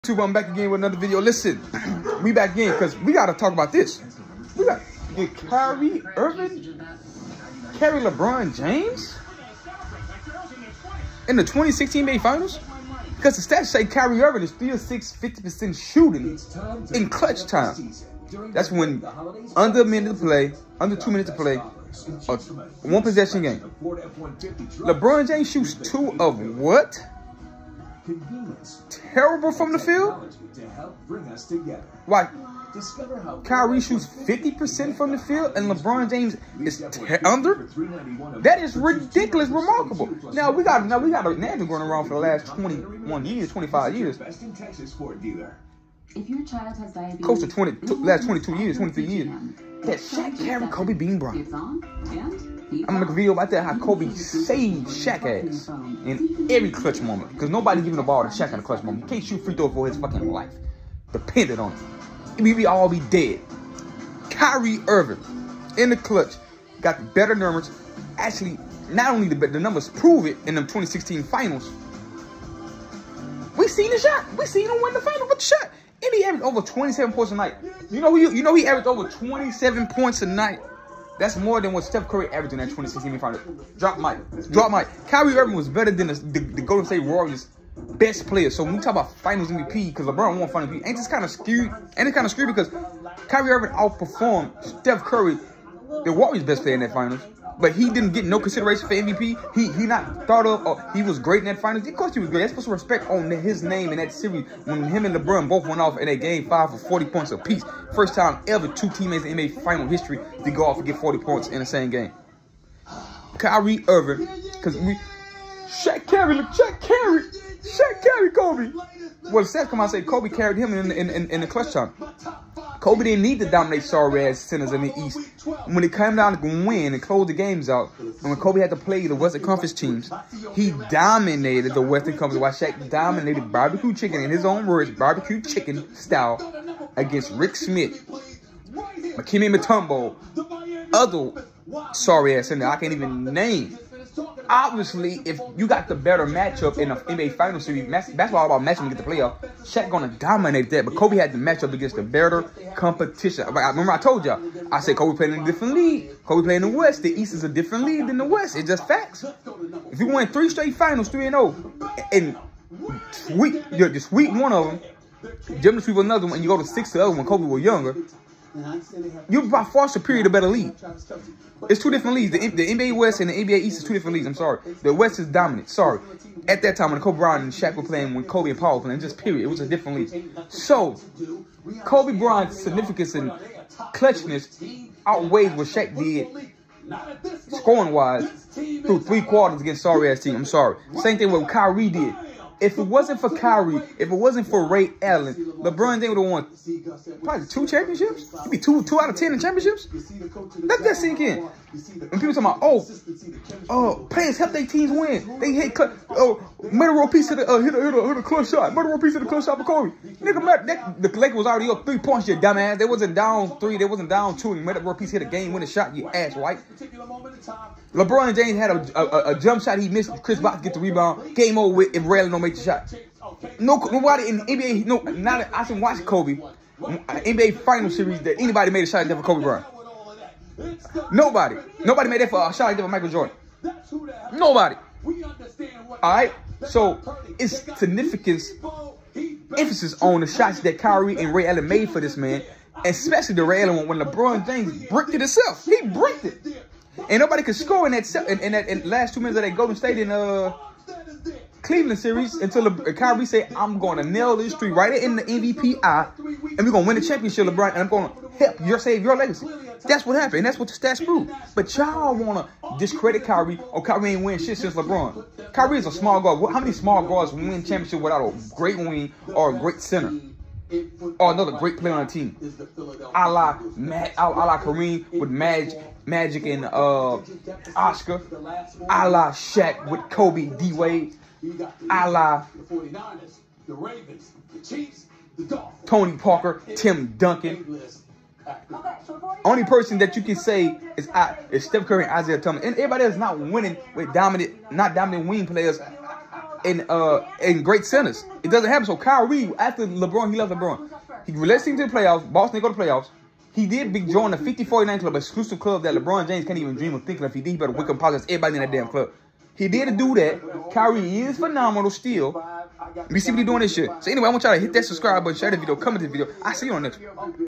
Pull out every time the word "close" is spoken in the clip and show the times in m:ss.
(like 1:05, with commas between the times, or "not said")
0:47, 2:07.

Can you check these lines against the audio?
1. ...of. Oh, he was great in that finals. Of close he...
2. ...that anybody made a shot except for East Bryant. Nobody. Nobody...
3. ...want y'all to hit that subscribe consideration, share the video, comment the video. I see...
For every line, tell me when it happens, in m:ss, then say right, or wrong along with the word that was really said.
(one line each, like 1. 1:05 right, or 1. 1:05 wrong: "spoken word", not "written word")
1. 1:40 wrong: "course", not "close"
2. 3:48 wrong: "Kobe", not "East"
3. 5:14 wrong: "button", not "consideration".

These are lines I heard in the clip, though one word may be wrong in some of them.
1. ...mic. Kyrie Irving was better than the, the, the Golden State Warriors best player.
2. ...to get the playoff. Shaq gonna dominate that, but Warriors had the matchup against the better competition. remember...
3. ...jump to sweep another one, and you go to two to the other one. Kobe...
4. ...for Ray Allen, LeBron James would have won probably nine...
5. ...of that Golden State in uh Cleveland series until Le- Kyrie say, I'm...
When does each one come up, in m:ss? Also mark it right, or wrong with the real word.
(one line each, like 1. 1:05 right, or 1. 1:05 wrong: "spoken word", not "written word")
1. 1:24 right
2. 2:28 wrong: "Kobe", not "Warriors"
3. 2:45 wrong: "six", not "two"
4. 3:14 wrong: "two", not "nine"
5. 4:09 right.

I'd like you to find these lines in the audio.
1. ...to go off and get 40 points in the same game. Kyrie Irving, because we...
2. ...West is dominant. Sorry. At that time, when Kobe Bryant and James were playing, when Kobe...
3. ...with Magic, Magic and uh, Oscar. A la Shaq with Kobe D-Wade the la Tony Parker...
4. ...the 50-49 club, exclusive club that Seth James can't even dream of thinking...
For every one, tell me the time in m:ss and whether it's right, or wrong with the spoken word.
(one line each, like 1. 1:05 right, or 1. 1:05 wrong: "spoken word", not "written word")
1. 1:50 right
2. 2:54 wrong: "Shaq", not "James"
3. 4:35 right
4. 5:04 wrong: "LeBron", not "Seth".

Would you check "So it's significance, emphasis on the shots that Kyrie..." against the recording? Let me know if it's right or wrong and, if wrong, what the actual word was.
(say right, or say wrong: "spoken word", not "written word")
right.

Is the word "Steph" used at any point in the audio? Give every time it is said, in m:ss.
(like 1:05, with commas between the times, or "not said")
1:21, 1:34, 4:51.